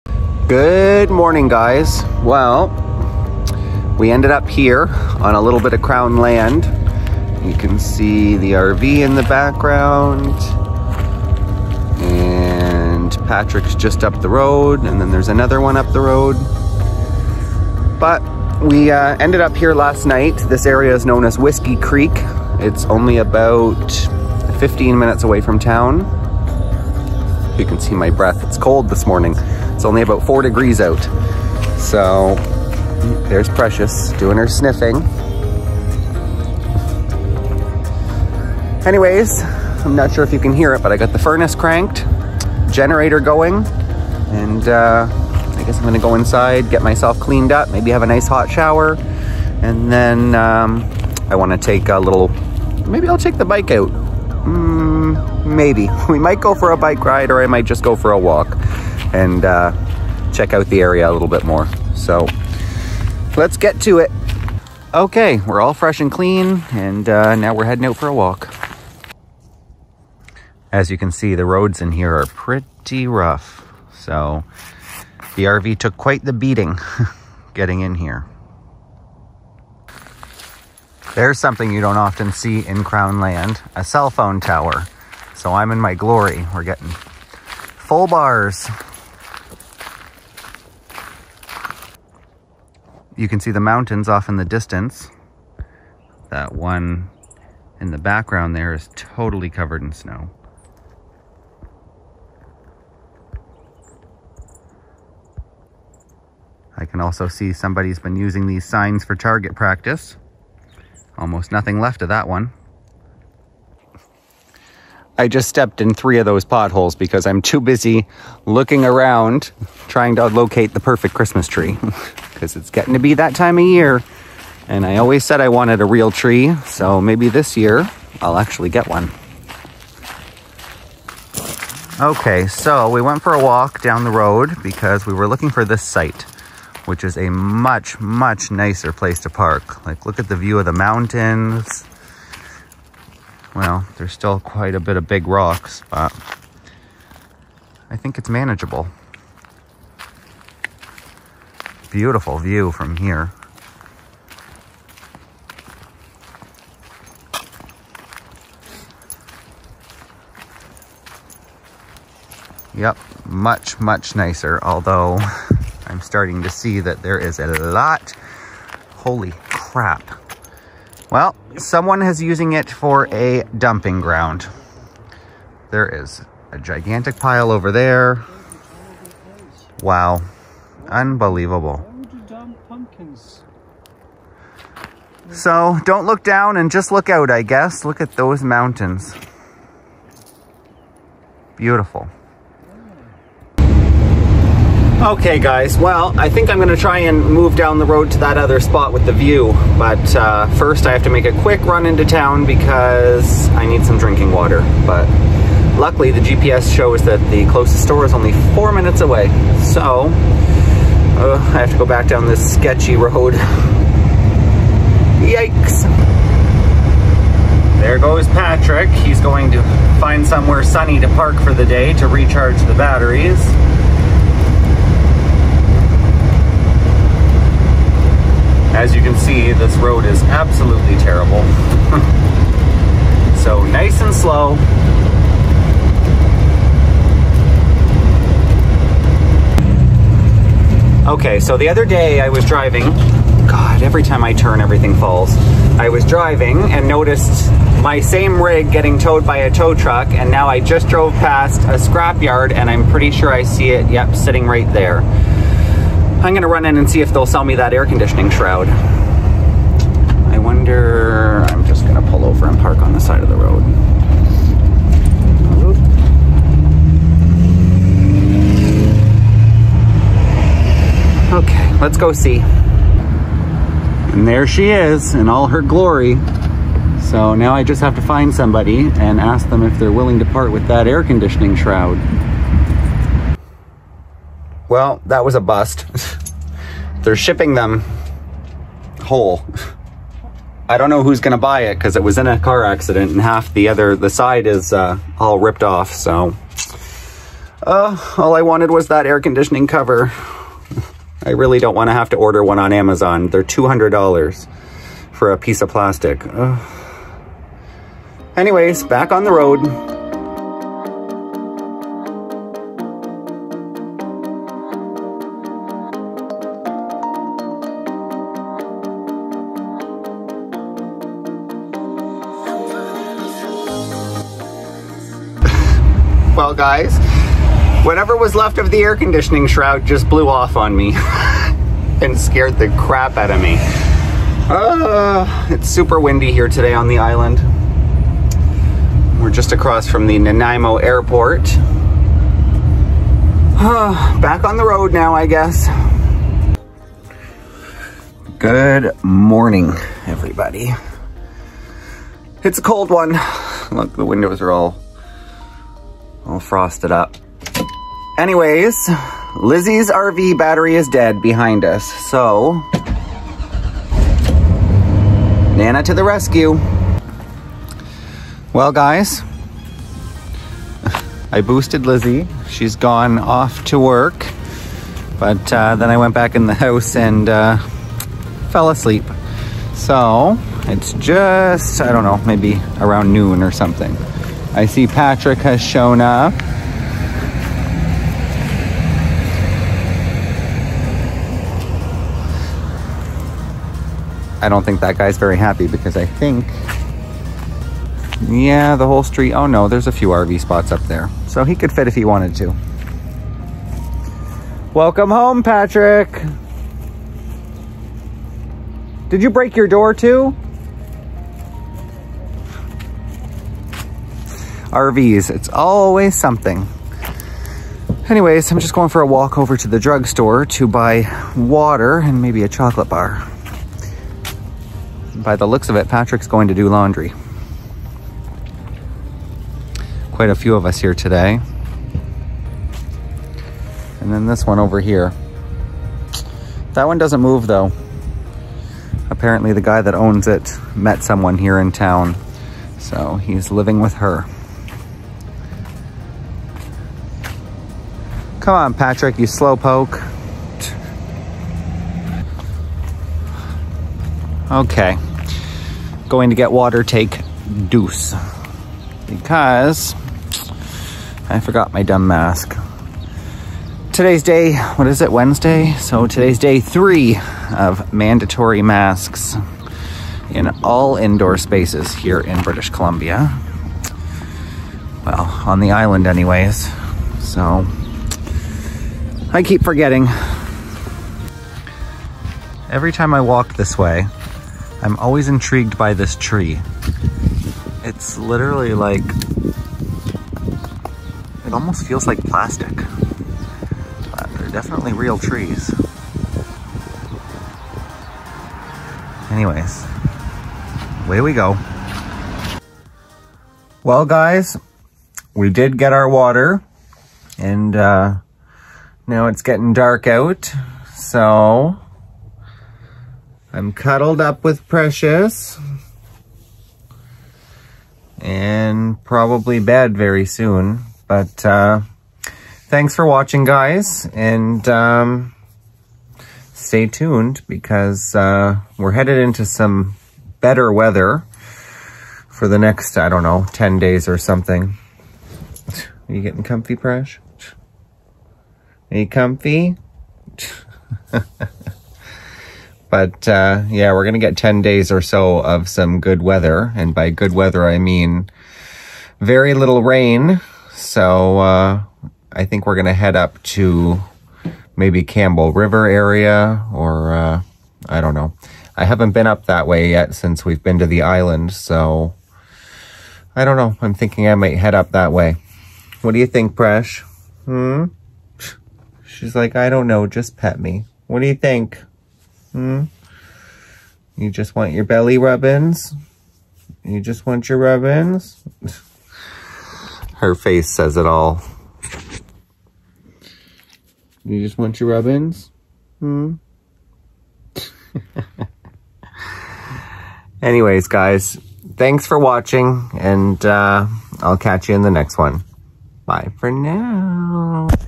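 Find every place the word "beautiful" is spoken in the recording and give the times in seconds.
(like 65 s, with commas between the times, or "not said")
151 s, 191 s.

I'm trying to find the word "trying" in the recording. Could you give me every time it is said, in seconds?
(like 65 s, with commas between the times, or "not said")
119 s.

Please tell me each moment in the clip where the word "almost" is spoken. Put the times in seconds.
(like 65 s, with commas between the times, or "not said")
111 s, 491 s.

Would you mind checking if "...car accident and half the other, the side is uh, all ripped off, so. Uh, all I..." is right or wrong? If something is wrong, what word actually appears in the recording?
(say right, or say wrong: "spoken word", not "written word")
right.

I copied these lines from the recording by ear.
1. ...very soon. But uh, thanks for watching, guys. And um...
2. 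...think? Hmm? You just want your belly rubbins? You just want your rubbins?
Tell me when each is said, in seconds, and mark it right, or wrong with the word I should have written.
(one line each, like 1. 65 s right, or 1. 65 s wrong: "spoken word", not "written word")
1. 519 s right
2. 571 s right.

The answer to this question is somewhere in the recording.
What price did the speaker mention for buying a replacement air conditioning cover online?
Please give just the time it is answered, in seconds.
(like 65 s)
303 s.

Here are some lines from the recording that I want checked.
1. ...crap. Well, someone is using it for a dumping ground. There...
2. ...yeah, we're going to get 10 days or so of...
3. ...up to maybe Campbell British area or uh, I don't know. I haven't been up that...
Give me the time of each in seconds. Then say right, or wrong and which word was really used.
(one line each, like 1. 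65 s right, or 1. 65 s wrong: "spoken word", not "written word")
1. 169 s right
2. 543 s right
3. 553 s wrong: "River", not "British".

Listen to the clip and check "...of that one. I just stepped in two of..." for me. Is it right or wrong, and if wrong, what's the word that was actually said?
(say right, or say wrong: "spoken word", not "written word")
wrong: "three", not "two".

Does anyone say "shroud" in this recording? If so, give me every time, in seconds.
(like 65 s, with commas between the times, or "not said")
258 s, 281 s, 329 s.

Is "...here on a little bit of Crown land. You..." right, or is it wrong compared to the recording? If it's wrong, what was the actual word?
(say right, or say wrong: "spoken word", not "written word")
right.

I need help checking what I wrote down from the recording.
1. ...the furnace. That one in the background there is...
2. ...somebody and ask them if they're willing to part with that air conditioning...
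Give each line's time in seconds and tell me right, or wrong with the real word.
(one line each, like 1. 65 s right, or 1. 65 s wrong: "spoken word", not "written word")
1. 94 s wrong: "distance", not "furnace"
2. 278 s right.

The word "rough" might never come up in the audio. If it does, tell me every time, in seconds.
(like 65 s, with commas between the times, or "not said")
73 s.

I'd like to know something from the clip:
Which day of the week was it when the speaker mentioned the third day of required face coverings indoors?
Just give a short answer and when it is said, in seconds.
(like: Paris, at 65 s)
Wednesday, at 465 s.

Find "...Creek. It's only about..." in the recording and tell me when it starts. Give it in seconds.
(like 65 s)
21 s.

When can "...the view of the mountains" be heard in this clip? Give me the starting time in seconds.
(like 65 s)
140 s.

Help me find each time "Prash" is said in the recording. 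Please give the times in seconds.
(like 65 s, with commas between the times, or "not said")
536 s.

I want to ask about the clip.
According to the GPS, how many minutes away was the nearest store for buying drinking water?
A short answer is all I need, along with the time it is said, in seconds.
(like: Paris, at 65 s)
4, at 208 s.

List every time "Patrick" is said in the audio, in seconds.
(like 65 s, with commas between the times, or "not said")
13 s, 218 s, 384 s, 405 s, 425 s, 448 s.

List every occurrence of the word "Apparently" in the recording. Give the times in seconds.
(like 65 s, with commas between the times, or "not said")
439 s.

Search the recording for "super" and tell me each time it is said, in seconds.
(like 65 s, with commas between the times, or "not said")
335 s.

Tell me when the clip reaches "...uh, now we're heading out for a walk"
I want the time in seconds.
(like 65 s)
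67 s.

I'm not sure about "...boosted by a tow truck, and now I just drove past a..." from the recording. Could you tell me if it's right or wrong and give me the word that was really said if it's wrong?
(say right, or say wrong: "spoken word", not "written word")
wrong: "towed", not "boosted".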